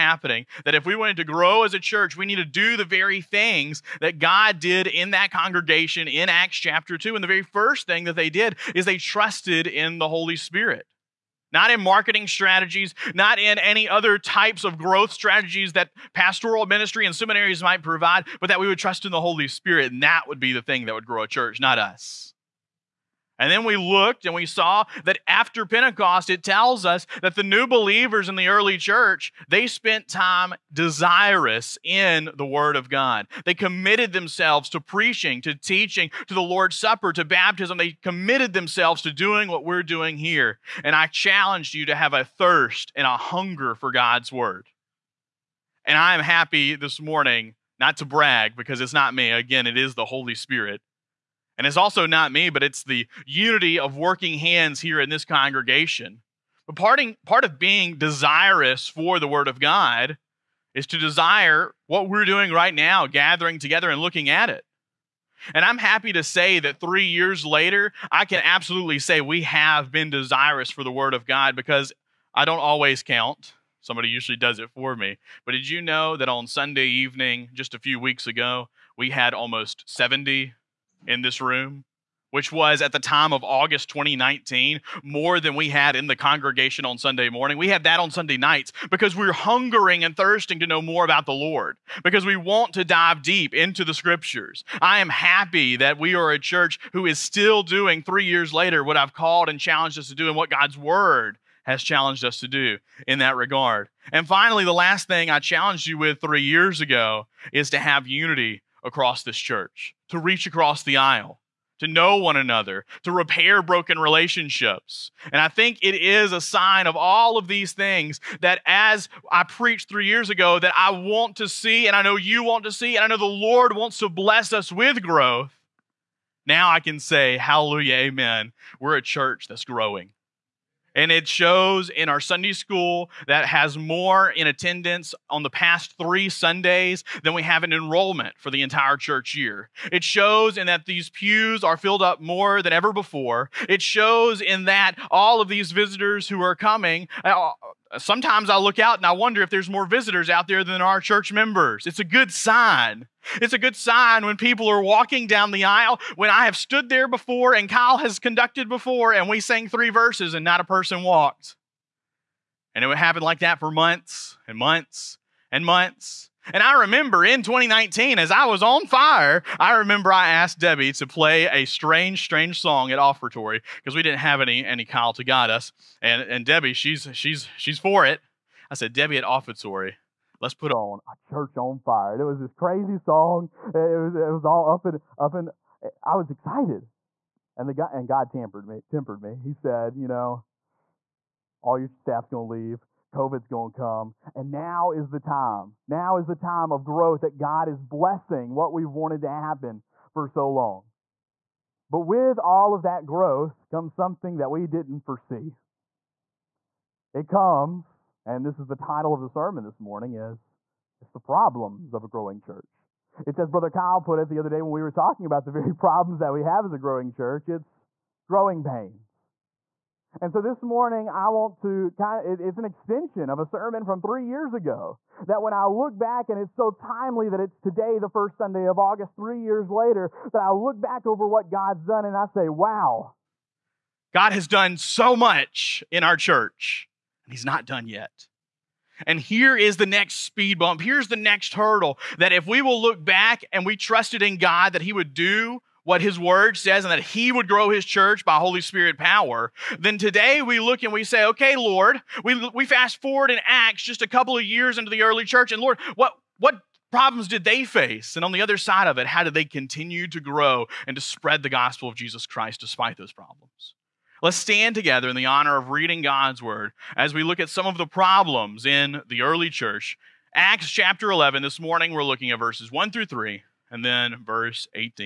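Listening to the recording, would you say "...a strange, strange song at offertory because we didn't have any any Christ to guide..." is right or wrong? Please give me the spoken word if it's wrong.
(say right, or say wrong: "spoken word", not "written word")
wrong: "Kyle", not "Christ".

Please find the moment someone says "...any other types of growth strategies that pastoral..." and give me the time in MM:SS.
00:13.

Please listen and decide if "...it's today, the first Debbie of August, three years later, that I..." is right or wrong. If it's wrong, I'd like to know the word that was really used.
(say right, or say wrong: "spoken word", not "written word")
wrong: "Sunday", not "Debbie".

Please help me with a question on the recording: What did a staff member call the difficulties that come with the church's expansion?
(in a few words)
growing pains.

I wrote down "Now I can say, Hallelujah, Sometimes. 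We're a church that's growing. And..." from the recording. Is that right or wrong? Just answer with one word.
wrong.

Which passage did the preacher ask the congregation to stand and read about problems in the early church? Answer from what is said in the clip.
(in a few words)
Acts chapter 11.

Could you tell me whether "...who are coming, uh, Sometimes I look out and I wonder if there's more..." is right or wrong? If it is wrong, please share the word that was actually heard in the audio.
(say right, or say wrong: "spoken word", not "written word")
right.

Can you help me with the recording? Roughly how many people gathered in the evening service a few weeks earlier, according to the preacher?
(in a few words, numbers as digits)
70.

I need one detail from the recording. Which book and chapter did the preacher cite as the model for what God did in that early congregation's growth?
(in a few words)
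Acts chapter 2.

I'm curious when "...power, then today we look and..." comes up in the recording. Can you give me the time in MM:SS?
04:08.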